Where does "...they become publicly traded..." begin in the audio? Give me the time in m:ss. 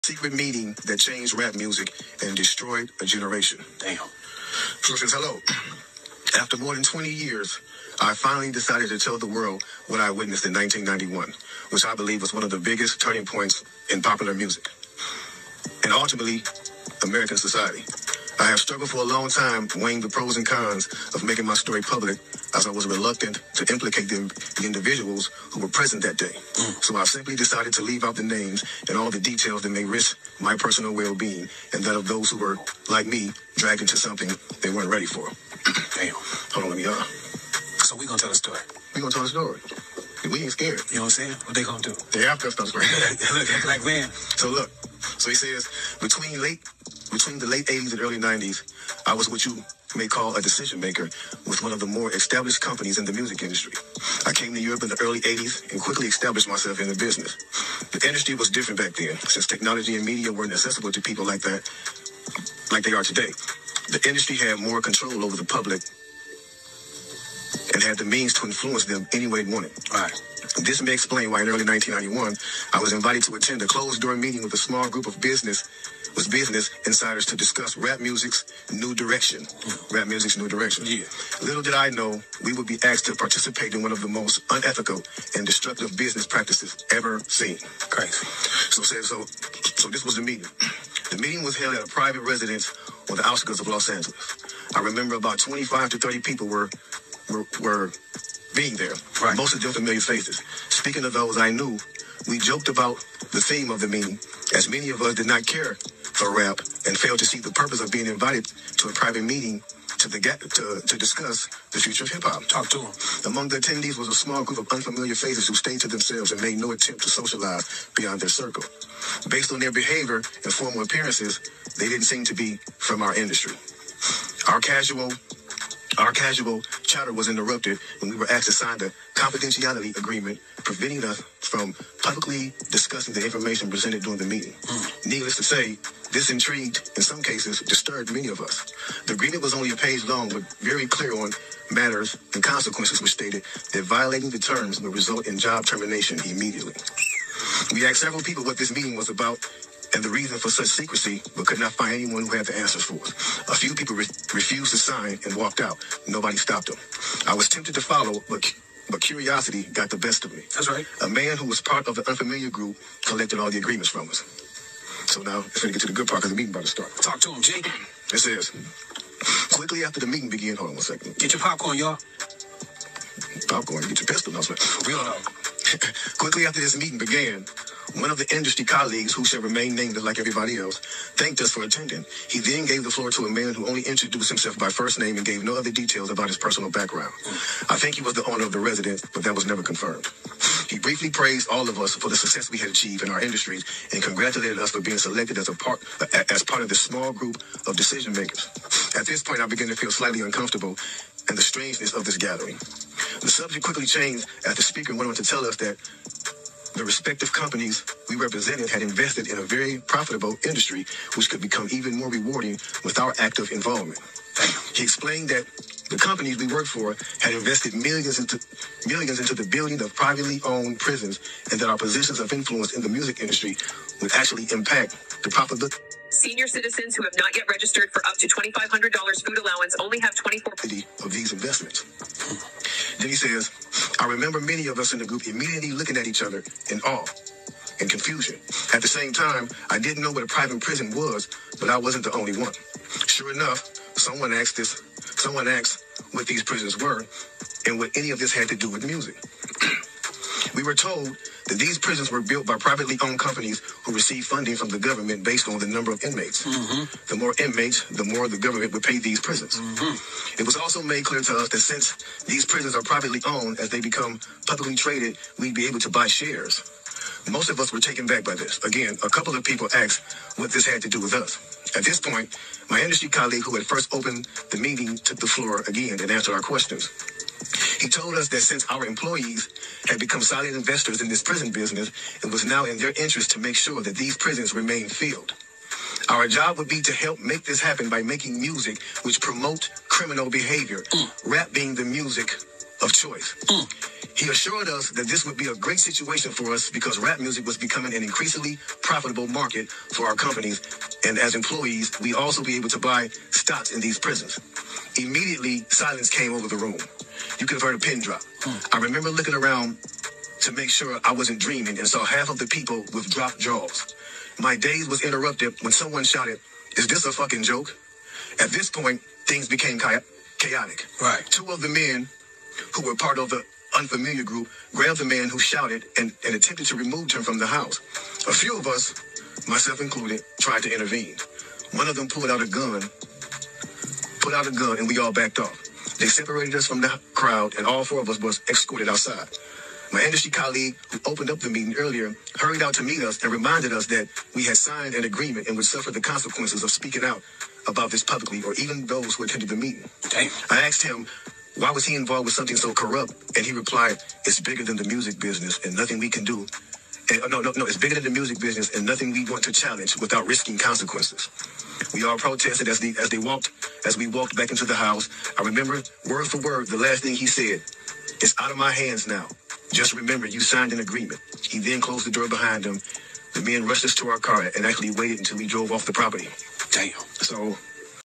4:23.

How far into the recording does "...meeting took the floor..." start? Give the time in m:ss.
4:34.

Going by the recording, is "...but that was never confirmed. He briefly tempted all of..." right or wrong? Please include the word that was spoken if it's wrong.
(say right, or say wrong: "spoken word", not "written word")
wrong: "praised", not "tempted".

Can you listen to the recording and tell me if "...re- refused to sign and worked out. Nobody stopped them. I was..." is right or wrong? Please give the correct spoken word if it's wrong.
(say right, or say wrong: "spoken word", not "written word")
wrong: "walked", not "worked".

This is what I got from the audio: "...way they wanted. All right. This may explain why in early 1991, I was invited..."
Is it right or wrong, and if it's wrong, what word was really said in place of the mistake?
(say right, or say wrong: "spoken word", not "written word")
right.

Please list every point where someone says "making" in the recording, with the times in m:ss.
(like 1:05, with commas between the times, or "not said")
0:21, 4:48.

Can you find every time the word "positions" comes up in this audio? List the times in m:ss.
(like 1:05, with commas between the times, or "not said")
3:41.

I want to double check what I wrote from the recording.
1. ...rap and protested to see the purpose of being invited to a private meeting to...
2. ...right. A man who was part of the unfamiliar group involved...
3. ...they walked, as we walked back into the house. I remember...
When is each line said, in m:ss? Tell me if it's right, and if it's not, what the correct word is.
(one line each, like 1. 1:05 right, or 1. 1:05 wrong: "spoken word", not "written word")
1. 1:46 wrong: "failed", not "protested"
2. 2:40 wrong: "collected", not "involved"
3. 6:03 right.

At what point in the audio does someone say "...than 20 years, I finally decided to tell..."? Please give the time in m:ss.
0:06.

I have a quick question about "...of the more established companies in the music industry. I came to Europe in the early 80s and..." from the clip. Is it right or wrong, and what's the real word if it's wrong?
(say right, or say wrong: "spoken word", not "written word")
right.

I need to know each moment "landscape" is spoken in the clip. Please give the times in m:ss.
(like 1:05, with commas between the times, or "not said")
not said.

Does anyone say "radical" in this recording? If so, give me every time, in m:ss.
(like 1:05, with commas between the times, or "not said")
not said.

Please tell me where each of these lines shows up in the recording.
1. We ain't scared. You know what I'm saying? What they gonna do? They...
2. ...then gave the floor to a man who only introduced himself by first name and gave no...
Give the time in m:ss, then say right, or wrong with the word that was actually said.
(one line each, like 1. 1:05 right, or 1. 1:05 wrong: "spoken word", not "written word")
1. 0:40 right
2. 3:02 right.